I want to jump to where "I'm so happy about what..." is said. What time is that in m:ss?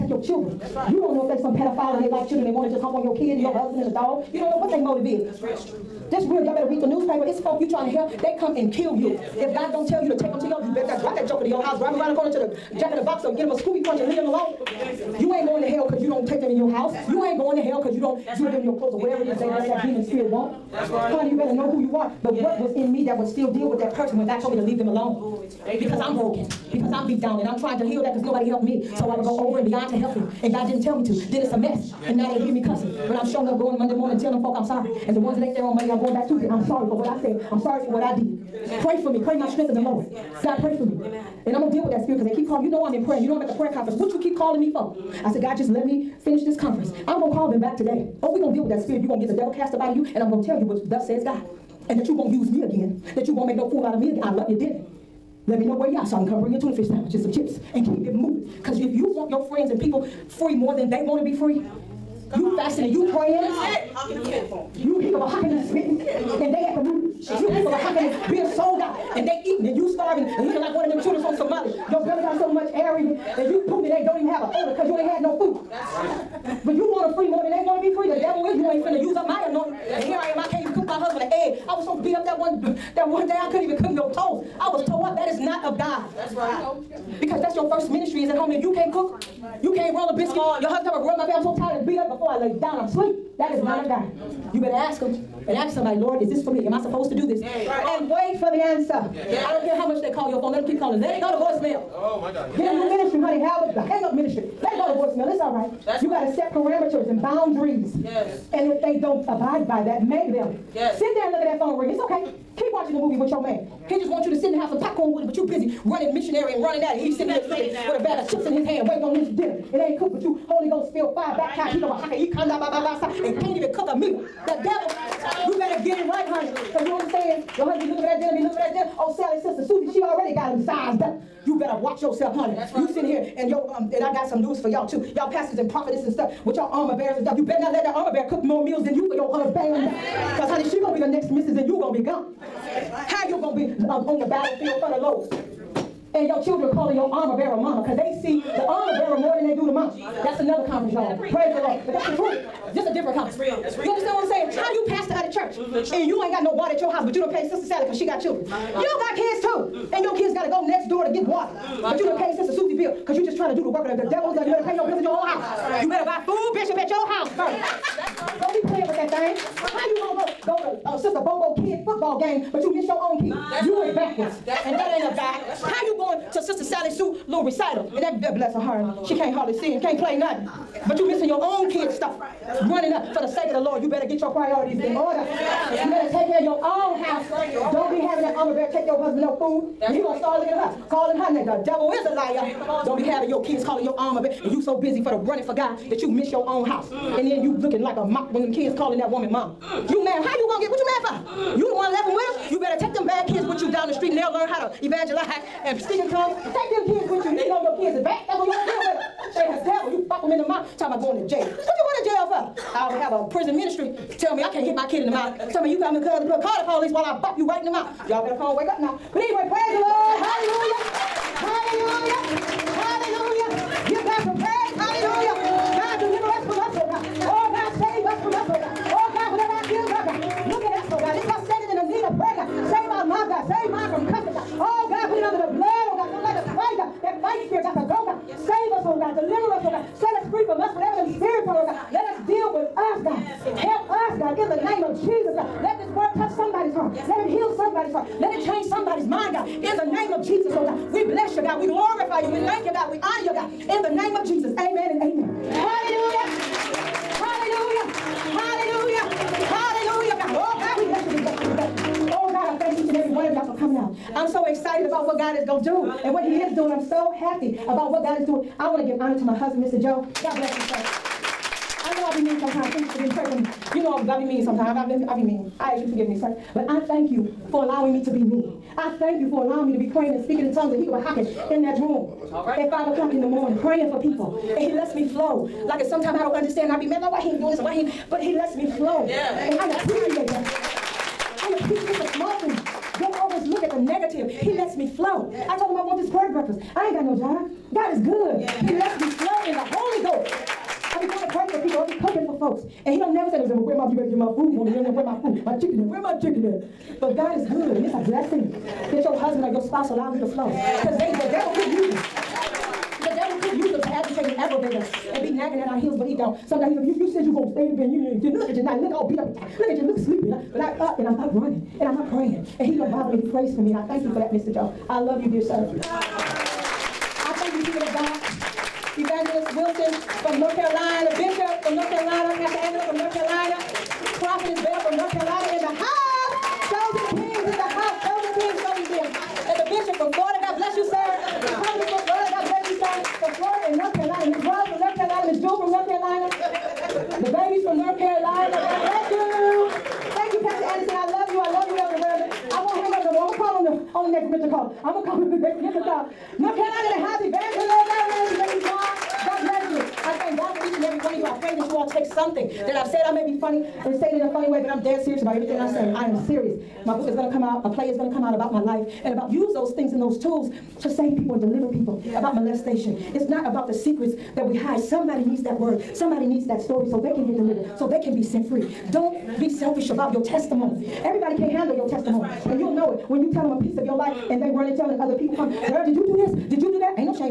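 4:26.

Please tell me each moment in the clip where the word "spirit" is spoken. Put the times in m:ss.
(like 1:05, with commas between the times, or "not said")
0:20, 0:42, 0:48.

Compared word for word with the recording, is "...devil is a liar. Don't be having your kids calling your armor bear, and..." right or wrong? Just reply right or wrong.
right.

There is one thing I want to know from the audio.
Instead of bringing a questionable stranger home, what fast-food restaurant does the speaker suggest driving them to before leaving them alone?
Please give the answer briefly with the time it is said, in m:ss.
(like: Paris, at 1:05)
Jack in the Box, at 0:12.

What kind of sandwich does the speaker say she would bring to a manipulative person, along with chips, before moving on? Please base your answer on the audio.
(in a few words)
Tuna fish.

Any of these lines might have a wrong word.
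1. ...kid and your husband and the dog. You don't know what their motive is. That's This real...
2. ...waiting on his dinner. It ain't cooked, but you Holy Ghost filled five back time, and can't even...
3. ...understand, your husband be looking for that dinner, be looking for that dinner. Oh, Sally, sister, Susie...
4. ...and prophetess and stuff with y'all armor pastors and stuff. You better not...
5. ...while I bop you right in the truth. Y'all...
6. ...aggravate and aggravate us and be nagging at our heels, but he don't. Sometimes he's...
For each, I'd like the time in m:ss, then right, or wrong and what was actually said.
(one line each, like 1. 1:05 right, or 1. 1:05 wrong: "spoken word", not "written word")
1. 0:03 right
2. 1:58 right
3. 2:06 right
4. 2:15 wrong: "bearers", not "pastors"
5. 3:36 wrong: "mouth", not "truth"
6. 5:13 wrong: "agitate", not "aggravate".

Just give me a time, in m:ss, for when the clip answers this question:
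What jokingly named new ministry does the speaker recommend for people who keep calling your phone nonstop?
1:43.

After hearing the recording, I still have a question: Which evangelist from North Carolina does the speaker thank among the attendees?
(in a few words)
Evangelist Wilson.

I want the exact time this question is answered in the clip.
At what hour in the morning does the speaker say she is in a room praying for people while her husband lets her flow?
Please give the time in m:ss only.
4:42.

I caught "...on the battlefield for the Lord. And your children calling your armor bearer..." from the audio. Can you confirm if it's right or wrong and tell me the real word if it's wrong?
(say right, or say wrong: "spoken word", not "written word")
right.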